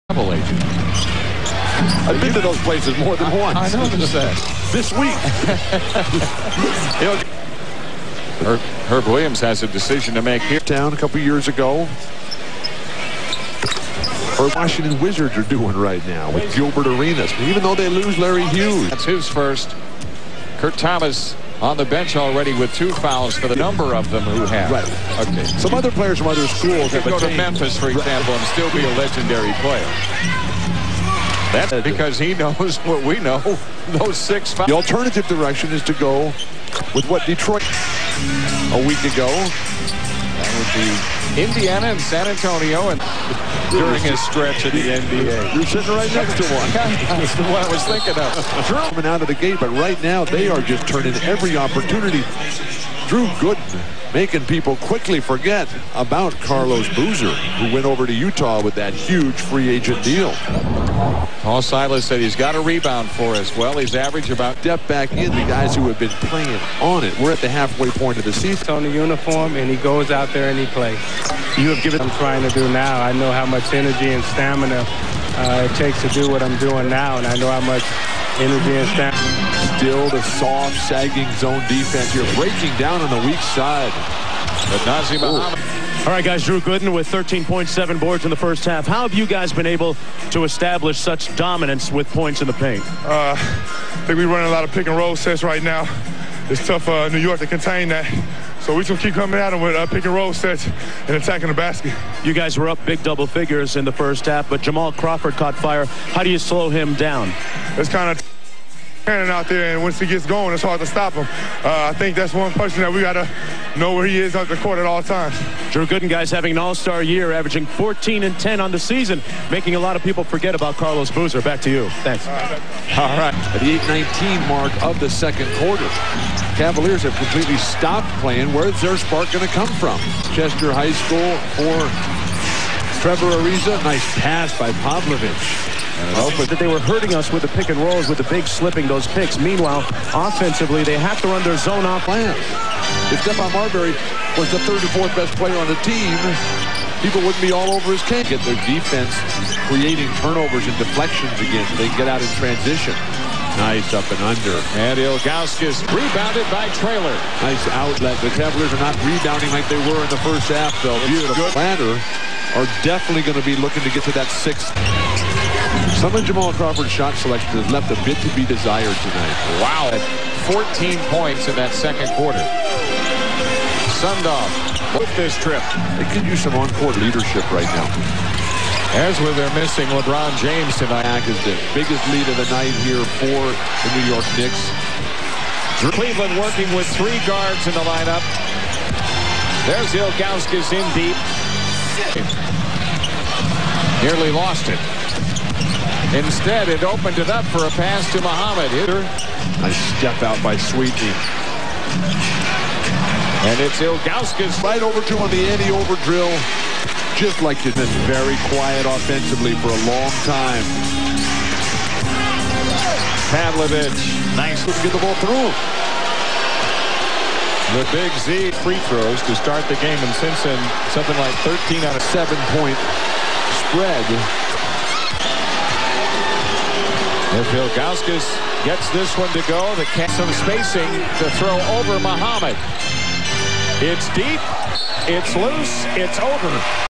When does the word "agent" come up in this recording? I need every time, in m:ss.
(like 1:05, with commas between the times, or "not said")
0:00, 0:59.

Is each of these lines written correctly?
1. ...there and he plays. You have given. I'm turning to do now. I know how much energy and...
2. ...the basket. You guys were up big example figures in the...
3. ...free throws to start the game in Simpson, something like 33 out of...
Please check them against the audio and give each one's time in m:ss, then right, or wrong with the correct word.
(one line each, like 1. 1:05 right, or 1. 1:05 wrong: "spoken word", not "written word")
1. 1:10 wrong: "trying", not "turning"
2. 1:41 wrong: "double", not "example"
3. 3:38 wrong: "13", not "33".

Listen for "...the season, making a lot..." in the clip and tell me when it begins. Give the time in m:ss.
1:58.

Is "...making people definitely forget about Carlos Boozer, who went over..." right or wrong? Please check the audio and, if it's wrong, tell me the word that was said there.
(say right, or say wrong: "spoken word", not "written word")
wrong: "quickly", not "definitely".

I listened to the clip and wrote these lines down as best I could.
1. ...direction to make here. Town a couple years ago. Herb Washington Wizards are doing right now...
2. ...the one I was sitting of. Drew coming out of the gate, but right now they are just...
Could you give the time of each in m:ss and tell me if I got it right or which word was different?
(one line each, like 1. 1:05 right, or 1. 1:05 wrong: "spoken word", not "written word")
1. 0:09 wrong: "decision", not "direction"
2. 0:47 wrong: "thinking", not "sitting".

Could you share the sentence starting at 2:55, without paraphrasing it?
They could use some on-court leadership right now.